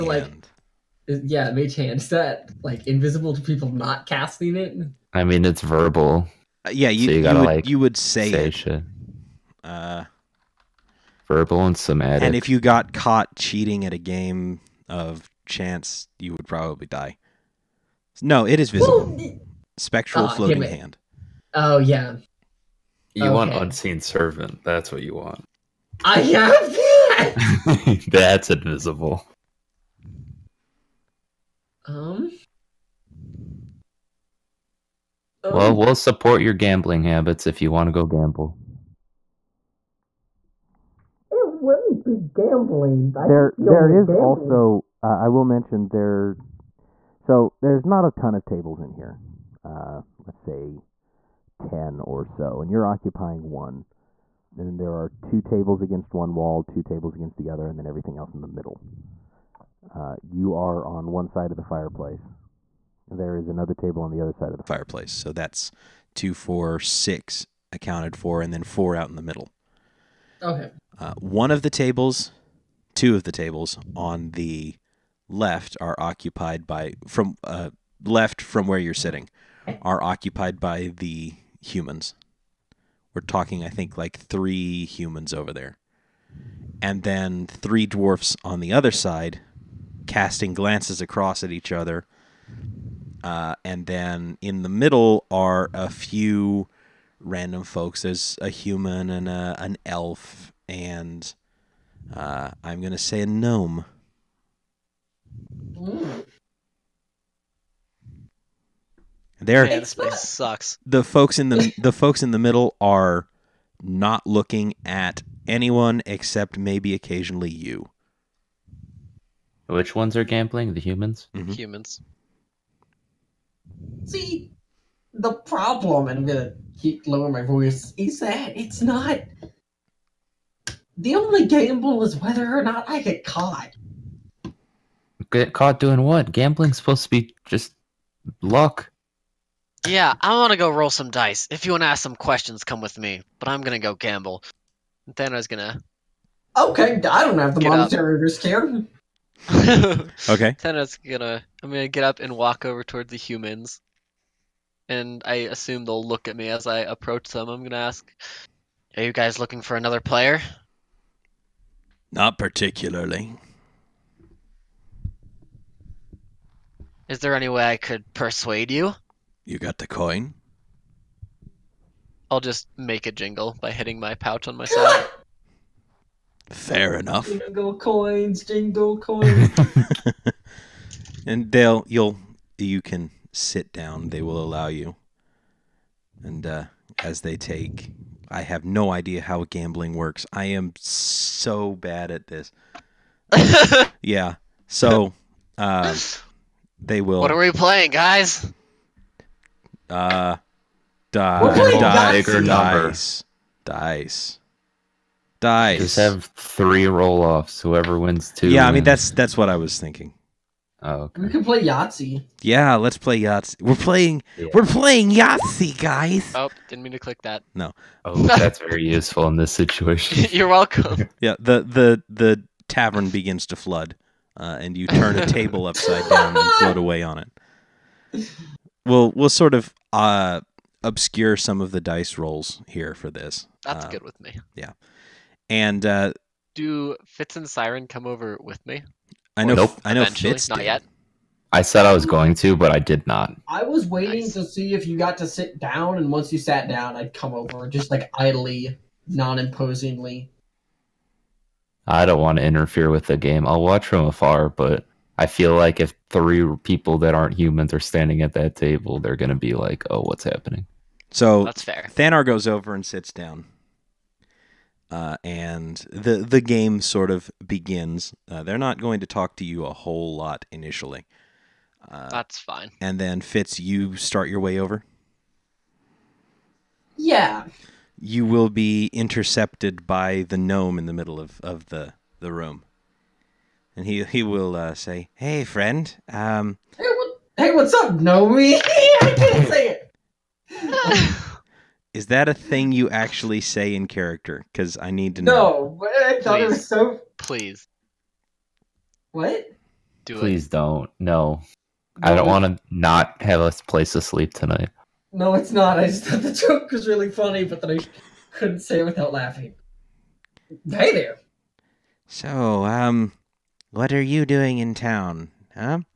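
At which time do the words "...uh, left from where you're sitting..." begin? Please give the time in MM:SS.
01:17.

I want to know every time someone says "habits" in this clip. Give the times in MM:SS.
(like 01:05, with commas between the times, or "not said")
00:37.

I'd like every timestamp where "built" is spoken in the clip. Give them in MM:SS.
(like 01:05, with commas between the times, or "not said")
not said.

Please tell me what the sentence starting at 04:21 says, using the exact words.
Thanar goes over and sits down, uh, and the the game sort of begins.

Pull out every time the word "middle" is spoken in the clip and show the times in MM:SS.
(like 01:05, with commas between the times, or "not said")
00:58, 01:09, 01:34, 01:52, 04:40.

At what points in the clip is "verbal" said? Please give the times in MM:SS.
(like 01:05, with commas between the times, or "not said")
00:05, 00:11.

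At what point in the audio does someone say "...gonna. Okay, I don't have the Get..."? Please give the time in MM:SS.
02:25.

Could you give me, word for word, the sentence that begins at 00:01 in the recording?
Is that like invisible to people not casting it?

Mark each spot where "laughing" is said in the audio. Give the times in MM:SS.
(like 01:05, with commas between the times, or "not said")
05:09.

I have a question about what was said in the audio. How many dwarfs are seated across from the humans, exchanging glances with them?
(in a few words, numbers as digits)
3.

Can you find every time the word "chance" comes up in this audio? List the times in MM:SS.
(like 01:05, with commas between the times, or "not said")
00:15.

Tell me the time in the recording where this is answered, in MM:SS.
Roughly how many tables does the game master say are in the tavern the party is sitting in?
00:51.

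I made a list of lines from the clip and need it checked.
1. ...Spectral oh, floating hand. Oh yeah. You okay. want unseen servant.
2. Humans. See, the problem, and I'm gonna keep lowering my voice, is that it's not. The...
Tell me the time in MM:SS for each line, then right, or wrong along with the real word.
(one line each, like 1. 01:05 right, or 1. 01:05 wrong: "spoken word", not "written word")
1. 00:19 right
2. 02:01 right.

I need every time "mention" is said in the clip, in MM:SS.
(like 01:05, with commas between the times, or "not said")
00:45.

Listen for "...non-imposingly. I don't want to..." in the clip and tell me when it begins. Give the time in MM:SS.
04:09.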